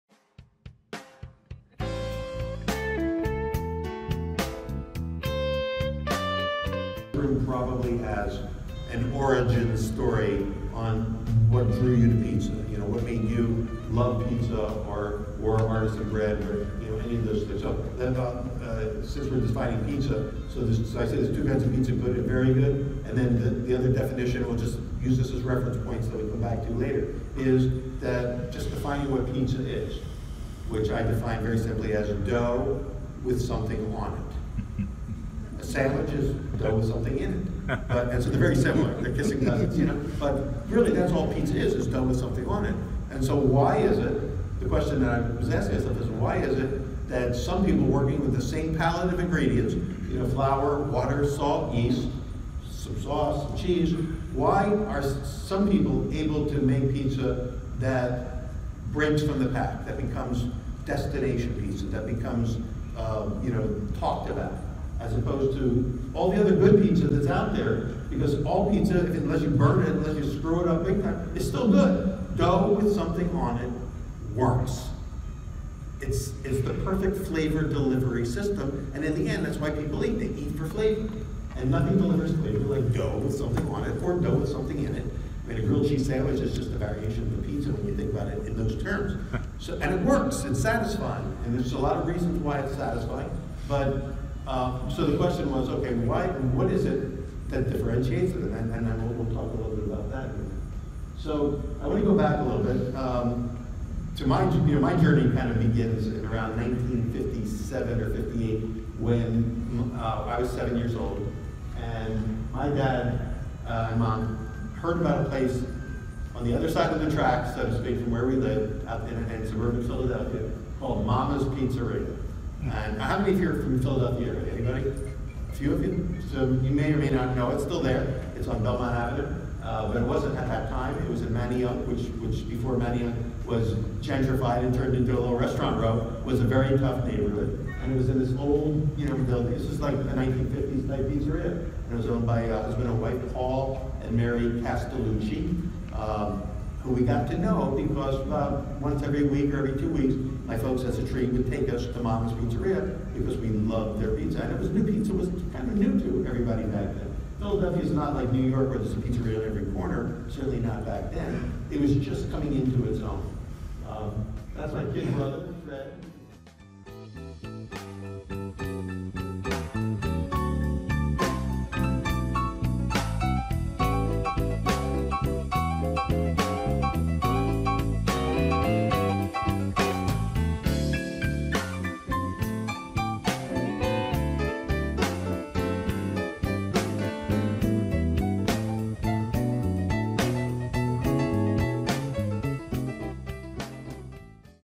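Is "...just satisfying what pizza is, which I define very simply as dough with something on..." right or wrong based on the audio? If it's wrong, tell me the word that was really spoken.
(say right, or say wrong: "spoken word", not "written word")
wrong: "defining", not "satisfying".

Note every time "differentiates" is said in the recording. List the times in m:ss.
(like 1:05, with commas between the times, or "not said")
1:37.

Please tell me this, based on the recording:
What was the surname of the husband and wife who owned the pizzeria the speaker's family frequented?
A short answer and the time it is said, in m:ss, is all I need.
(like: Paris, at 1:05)
Castellucci, at 2:24.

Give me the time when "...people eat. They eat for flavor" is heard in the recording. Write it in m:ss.
1:19.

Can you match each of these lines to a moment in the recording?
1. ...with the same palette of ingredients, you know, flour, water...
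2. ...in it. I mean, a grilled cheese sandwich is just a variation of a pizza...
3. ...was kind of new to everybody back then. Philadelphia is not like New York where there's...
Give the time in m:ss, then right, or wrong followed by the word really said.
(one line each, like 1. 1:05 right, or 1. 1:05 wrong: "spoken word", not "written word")
1. 0:48 right
2. 1:24 right
3. 2:35 right.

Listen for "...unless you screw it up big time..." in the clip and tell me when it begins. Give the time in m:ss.
1:09.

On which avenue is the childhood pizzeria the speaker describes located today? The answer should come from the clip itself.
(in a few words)
Belmont Avenue.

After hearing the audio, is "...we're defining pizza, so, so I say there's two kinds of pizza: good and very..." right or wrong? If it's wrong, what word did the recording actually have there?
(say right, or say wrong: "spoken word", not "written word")
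right.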